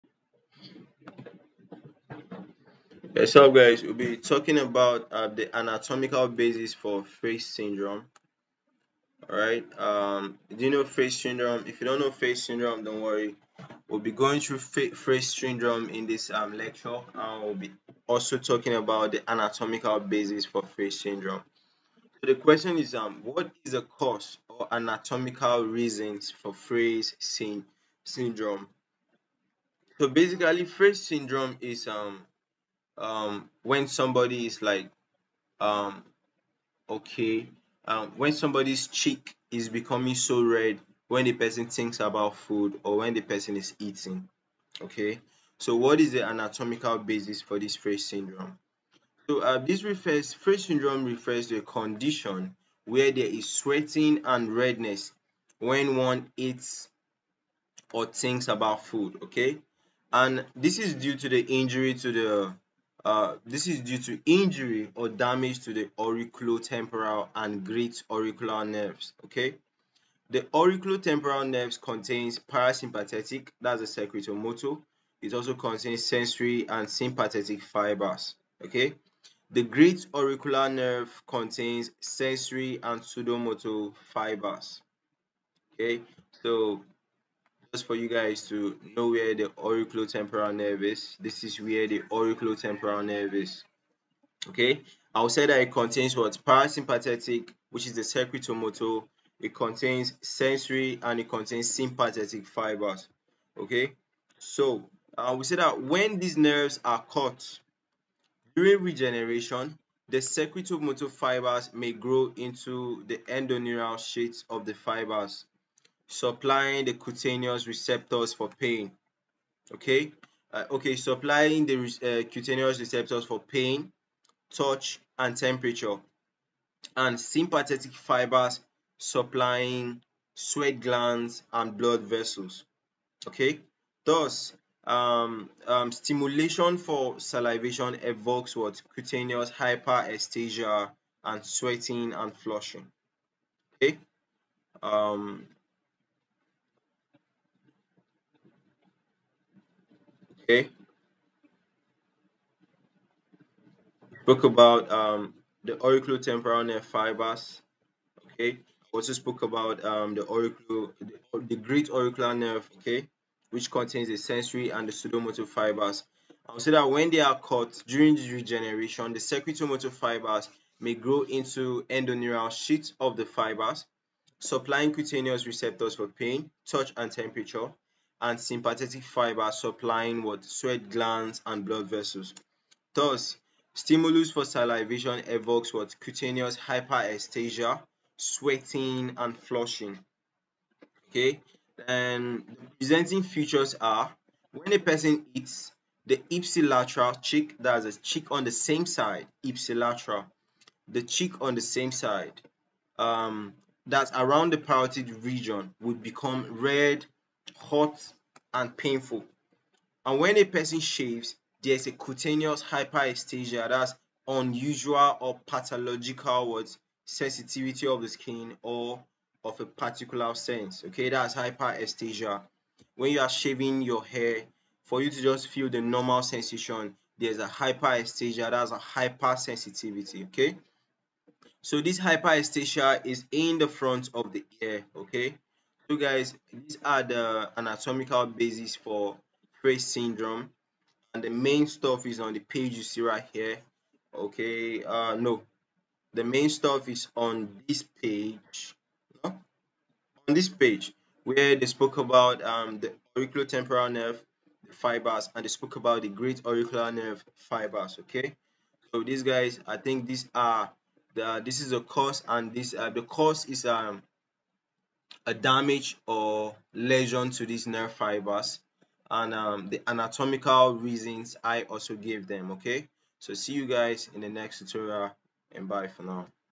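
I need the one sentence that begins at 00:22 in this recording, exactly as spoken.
So the question is, um, what is the cause or anatomical reasons for Frey's syndrome?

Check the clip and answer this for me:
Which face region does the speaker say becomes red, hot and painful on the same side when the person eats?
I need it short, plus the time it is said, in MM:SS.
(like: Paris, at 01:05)
Parotid region, at 03:24.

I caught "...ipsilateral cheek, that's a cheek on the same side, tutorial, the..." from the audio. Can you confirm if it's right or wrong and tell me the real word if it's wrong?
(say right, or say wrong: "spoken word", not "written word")
wrong: "ipsilateral", not "tutorial".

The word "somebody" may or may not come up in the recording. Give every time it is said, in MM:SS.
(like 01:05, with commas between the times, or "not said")
00:33, 00:38.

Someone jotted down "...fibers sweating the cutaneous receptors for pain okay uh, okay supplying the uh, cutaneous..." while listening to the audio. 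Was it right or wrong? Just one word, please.
wrong.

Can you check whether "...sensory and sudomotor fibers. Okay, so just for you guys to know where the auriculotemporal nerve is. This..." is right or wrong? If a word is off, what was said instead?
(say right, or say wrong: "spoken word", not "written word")
right.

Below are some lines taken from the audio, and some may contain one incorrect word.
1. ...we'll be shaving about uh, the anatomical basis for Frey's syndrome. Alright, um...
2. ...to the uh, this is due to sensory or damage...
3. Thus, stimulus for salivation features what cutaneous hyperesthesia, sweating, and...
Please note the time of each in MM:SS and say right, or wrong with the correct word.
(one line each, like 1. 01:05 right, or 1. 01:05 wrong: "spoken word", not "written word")
1. 00:03 wrong: "talking", not "shaving"
2. 01:01 wrong: "injury", not "sensory"
3. 03:02 wrong: "evokes", not "features".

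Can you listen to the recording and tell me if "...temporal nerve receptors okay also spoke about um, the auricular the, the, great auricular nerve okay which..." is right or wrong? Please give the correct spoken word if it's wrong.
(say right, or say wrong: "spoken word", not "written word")
wrong: "fibers", not "receptors".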